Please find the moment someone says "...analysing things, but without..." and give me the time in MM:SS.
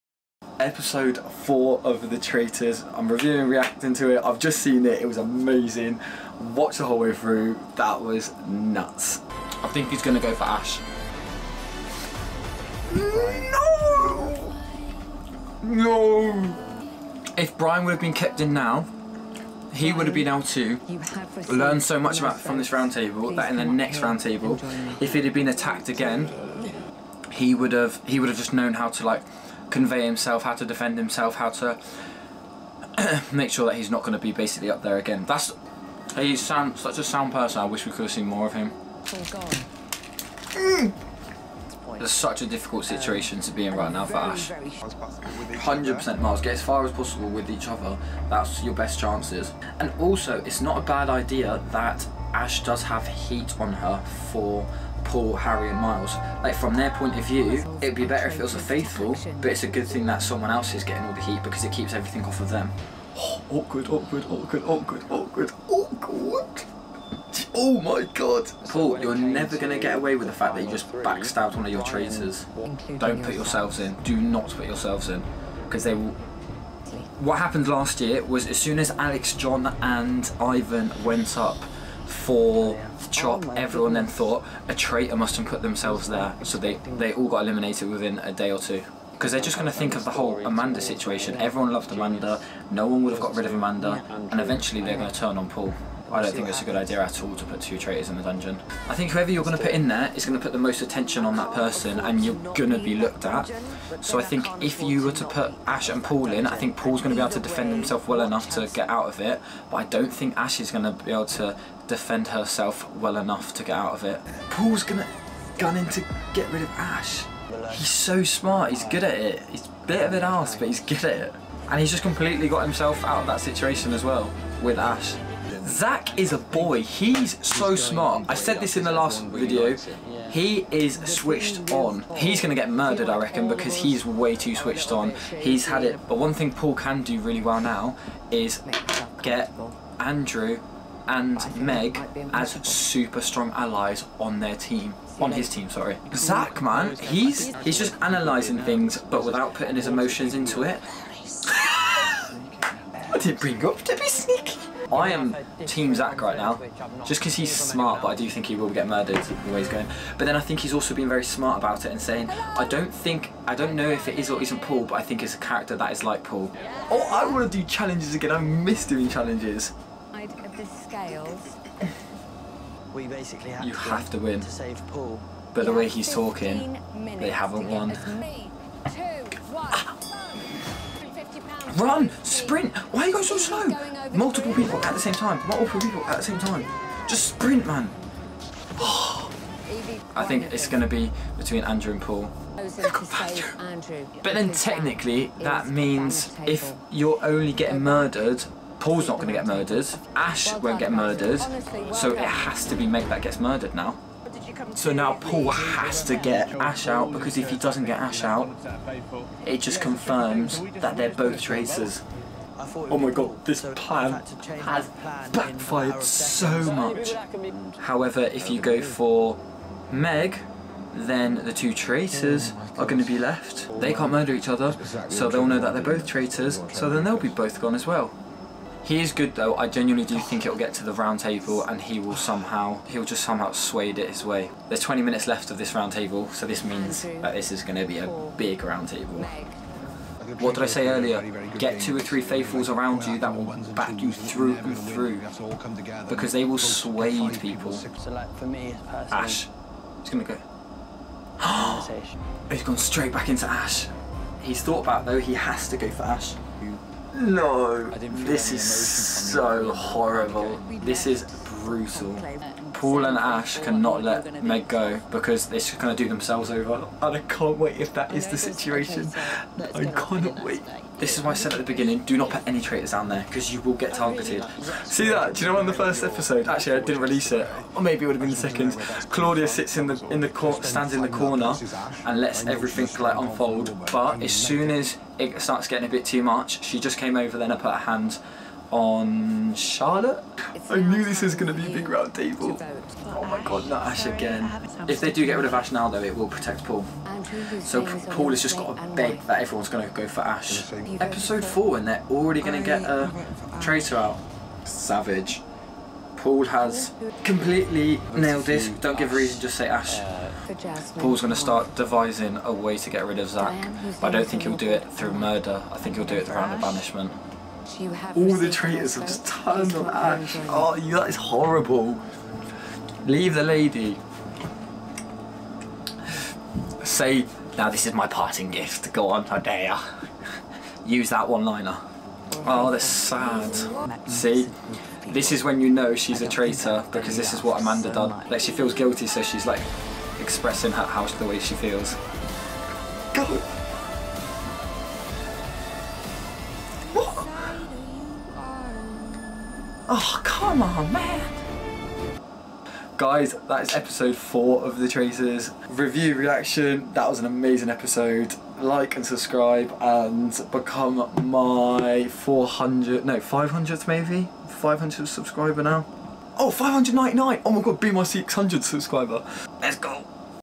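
02:28.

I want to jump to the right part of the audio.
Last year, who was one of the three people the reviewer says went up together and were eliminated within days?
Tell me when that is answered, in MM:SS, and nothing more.
01:20.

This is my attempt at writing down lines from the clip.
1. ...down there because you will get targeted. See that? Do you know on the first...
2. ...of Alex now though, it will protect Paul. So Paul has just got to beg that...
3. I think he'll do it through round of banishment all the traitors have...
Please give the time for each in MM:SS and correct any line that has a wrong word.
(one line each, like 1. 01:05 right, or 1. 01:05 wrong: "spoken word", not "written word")
1. 04:32 right
2. 04:55 wrong: "Ash", not "Alex"
3. 05:15 right.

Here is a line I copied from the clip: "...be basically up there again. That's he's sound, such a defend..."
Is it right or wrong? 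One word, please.
wrong.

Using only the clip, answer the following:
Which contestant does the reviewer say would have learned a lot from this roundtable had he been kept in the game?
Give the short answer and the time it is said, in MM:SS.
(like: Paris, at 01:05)
Brian, at 00:17.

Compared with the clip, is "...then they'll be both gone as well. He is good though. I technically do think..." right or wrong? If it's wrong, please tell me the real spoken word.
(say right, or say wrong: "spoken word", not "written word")
wrong: "genuinely", not "technically".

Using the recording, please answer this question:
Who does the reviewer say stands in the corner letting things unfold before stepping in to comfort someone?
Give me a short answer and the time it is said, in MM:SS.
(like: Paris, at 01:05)
Claudia, at 04:39.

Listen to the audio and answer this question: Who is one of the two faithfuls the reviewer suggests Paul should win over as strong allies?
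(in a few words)
Andrew and Meg.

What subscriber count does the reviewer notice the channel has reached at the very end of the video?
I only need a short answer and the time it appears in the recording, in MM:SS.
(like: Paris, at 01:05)
599, at 06:06.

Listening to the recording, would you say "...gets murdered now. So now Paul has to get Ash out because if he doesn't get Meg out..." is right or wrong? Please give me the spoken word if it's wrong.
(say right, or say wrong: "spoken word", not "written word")
wrong: "Ash", not "Meg".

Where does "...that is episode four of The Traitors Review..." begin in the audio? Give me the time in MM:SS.
05:53.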